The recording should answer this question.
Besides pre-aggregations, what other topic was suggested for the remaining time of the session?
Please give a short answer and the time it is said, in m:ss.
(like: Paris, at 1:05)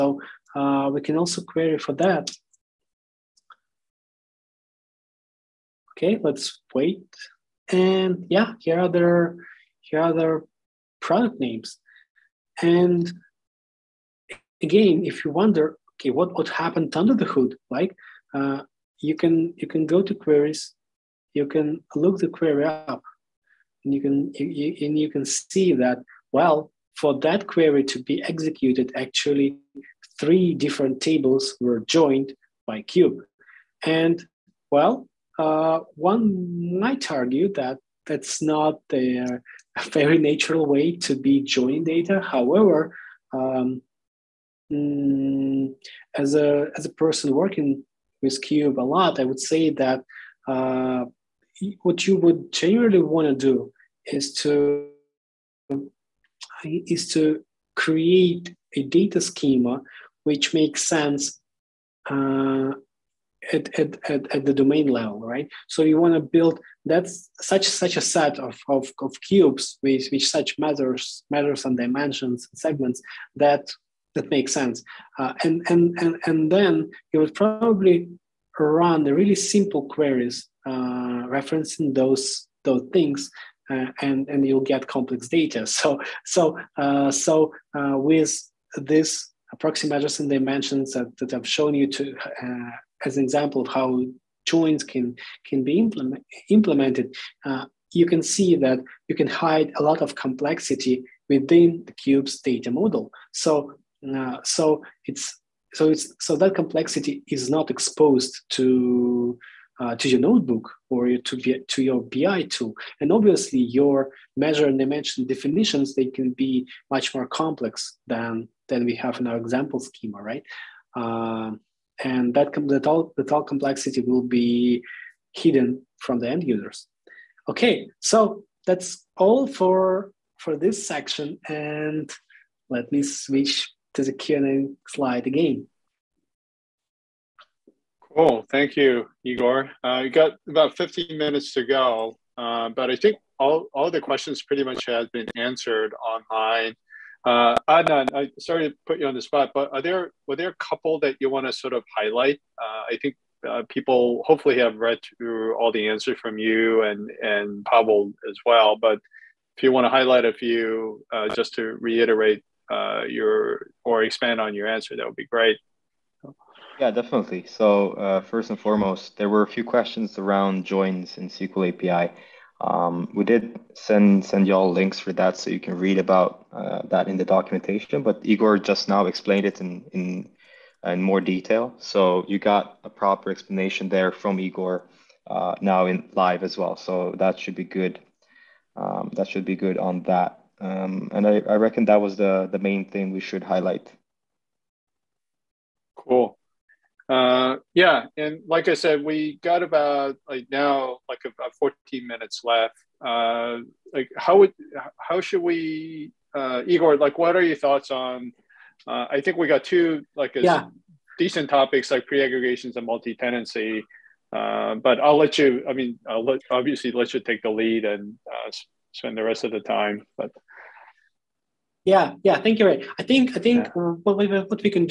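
multi-tenancy, at 3:32.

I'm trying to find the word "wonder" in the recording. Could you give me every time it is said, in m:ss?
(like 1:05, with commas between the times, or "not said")
0:15.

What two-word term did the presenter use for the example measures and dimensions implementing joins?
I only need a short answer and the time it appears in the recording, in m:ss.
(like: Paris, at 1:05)
proxy measures, at 1:29.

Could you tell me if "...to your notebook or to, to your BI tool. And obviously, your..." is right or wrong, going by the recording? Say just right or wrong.
right.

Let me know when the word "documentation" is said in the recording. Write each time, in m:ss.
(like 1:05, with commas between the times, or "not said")
2:57.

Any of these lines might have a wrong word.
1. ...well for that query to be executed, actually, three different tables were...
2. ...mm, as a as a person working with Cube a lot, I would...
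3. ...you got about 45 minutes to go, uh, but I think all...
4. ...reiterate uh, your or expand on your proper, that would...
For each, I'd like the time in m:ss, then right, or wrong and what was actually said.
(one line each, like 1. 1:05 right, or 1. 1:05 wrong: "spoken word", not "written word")
1. 0:26 right
2. 0:44 right
3. 2:20 wrong: "15", not "45"
4. 2:41 wrong: "answer", not "proper".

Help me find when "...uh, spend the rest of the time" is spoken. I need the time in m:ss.
3:38.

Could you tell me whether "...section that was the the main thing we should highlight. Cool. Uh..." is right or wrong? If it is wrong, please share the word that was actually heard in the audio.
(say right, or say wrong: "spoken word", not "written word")
wrong: "reckon", not "section".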